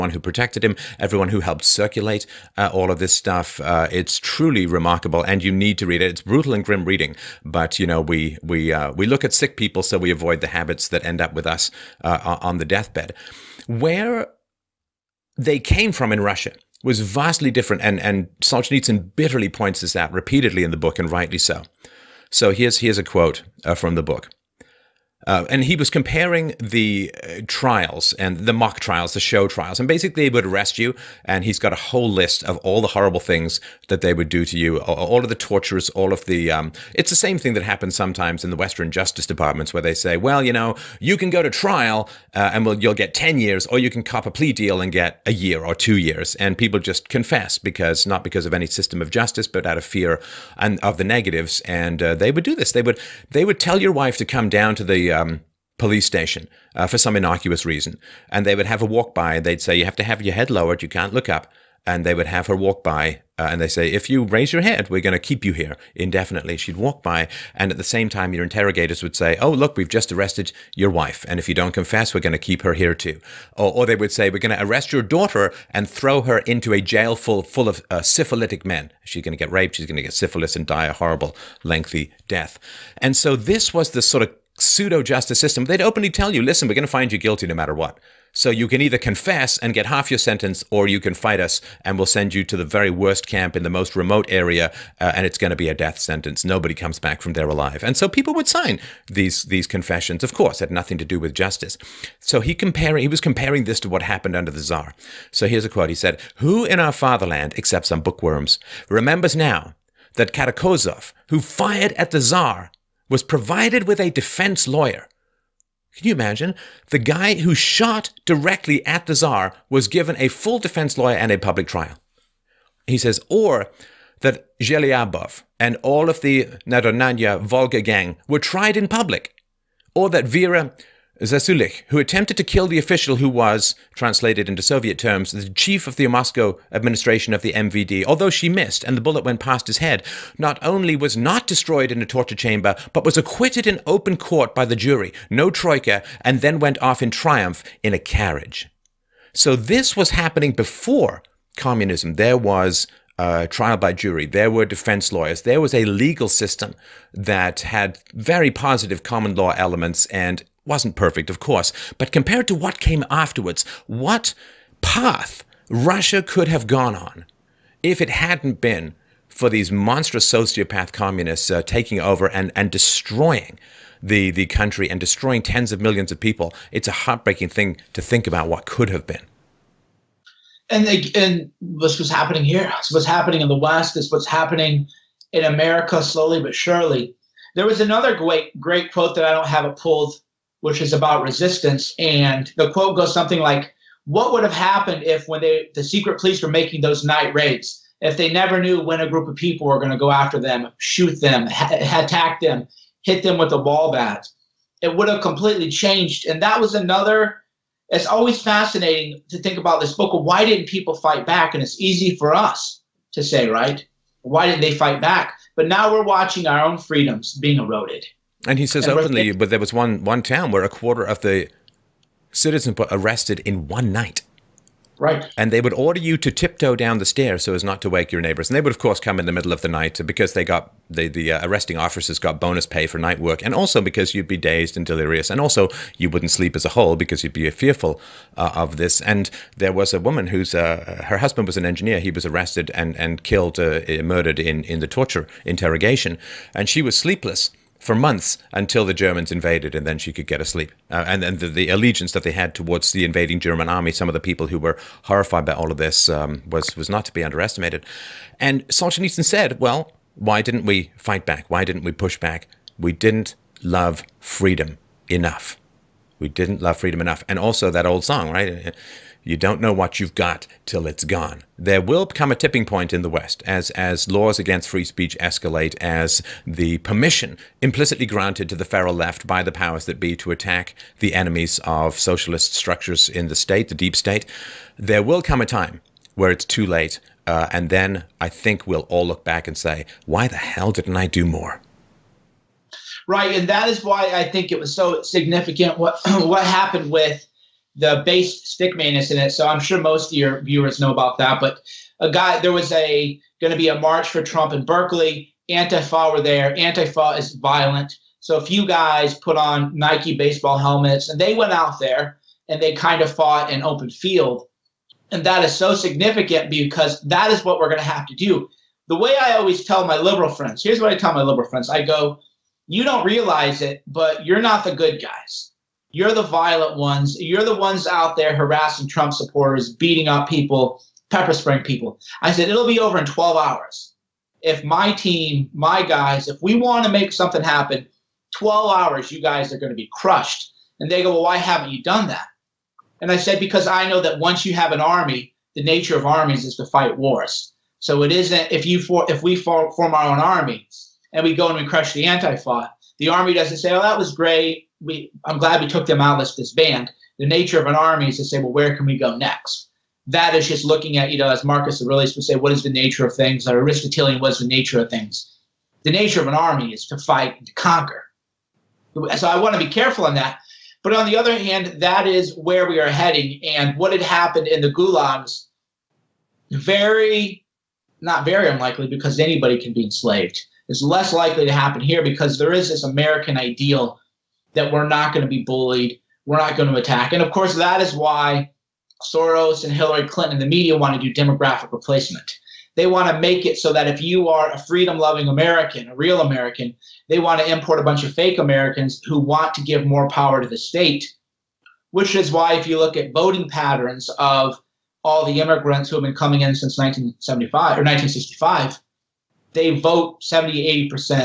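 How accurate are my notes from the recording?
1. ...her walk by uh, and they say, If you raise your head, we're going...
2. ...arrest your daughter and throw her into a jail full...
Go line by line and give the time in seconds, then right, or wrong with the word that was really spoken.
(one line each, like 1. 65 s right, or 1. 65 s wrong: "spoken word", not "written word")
1. 62 s right
2. 74 s right.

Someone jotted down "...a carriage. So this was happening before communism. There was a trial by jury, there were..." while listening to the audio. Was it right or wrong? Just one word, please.
right.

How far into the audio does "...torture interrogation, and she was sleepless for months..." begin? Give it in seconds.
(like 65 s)
244 s.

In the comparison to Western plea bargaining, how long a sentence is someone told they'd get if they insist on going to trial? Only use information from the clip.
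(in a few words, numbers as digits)
10 years.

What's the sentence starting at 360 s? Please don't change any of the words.
That is just looking at, you know, as Marcus Aurelius would say, what is the nature of things?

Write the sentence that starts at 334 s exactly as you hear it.
If my team, my guys, if we want to make something happen, 12 hours, you guys are going to be crushed.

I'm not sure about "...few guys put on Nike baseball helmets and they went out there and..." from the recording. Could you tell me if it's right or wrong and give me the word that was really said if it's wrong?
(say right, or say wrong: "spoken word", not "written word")
right.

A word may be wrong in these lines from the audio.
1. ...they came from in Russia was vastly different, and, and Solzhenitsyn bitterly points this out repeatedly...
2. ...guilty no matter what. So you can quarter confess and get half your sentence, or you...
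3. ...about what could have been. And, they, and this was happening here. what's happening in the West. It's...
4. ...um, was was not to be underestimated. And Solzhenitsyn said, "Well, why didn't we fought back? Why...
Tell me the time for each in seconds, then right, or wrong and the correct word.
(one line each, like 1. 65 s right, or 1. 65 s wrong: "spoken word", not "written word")
1. 15 s right
2. 87 s wrong: "either", not "quarter"
3. 178 s right
4. 256 s wrong: "fight", not "fought".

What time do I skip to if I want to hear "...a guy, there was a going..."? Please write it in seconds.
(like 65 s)
301 s.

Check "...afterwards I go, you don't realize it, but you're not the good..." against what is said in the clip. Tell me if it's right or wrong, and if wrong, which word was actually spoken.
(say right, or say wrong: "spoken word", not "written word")
wrong: "friends", not "afterwards".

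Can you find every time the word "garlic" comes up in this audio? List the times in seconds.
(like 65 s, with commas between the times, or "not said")
not said.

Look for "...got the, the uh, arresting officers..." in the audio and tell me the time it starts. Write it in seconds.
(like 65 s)
230 s.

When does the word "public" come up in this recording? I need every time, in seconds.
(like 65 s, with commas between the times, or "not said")
121 s, 128 s.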